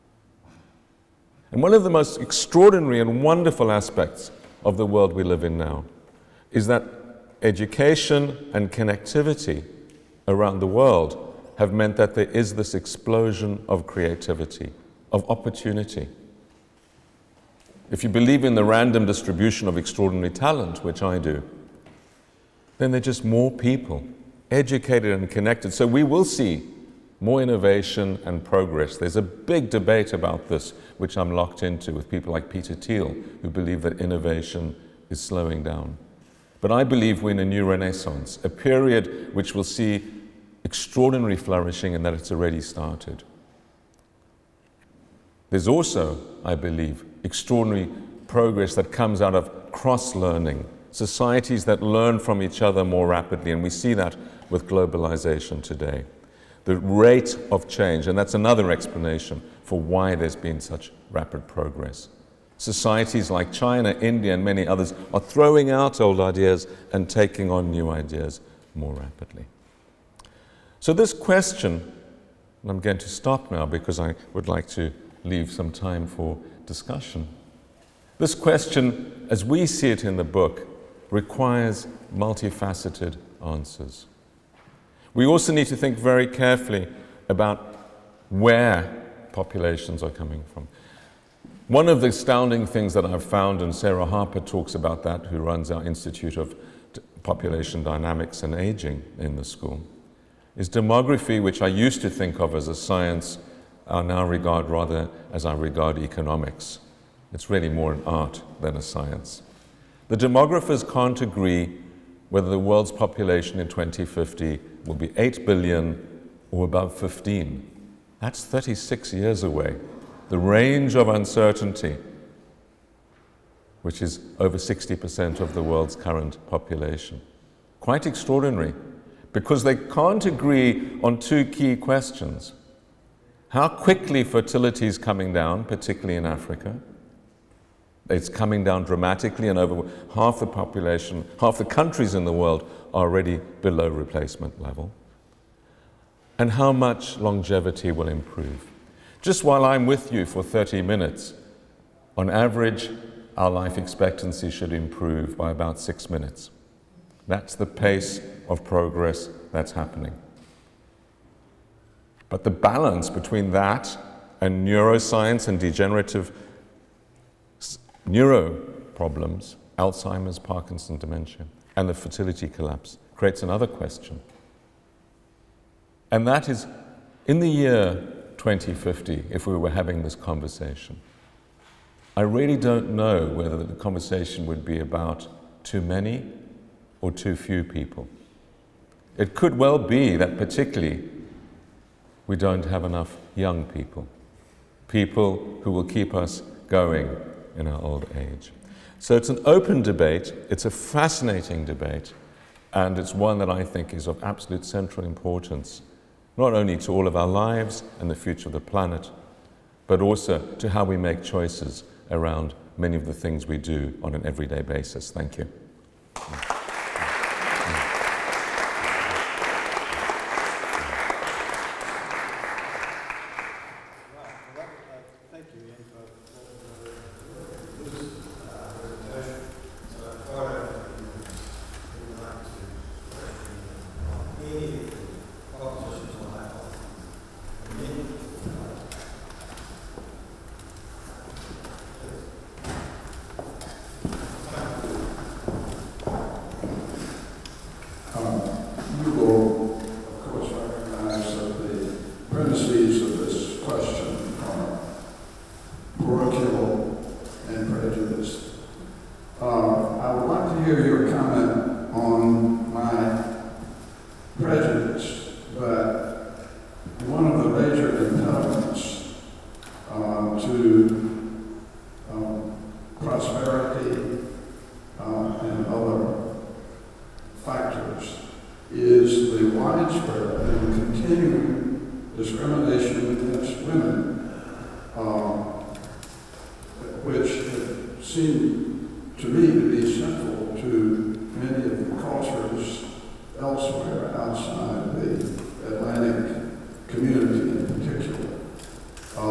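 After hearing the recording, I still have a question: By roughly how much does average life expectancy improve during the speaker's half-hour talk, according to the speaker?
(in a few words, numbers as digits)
6 minutes.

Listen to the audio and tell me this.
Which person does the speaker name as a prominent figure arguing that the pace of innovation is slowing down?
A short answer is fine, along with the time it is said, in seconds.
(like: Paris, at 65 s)
Peter Thiel, at 32 s.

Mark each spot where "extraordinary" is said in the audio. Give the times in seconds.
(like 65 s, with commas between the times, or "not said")
2 s, 19 s, 40 s, 47 s, 128 s.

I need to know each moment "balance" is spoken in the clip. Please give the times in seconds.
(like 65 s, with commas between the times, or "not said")
162 s.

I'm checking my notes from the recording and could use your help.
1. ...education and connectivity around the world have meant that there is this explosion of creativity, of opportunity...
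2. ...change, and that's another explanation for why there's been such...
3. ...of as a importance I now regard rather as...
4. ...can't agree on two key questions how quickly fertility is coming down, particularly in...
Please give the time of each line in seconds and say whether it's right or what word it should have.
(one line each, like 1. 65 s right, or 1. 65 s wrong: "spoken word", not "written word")
1. 7 s right
2. 57 s right
3. 102 s wrong: "science", not "importance"
4. 129 s right.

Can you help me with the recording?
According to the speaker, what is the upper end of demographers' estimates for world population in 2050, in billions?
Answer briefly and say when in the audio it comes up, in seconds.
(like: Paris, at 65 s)
15, at 116 s.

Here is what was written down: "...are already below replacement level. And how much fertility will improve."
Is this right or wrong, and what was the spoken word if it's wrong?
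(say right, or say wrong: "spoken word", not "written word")
wrong: "longevity", not "fertility".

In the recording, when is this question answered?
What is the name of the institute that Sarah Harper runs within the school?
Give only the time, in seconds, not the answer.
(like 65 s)
95 s.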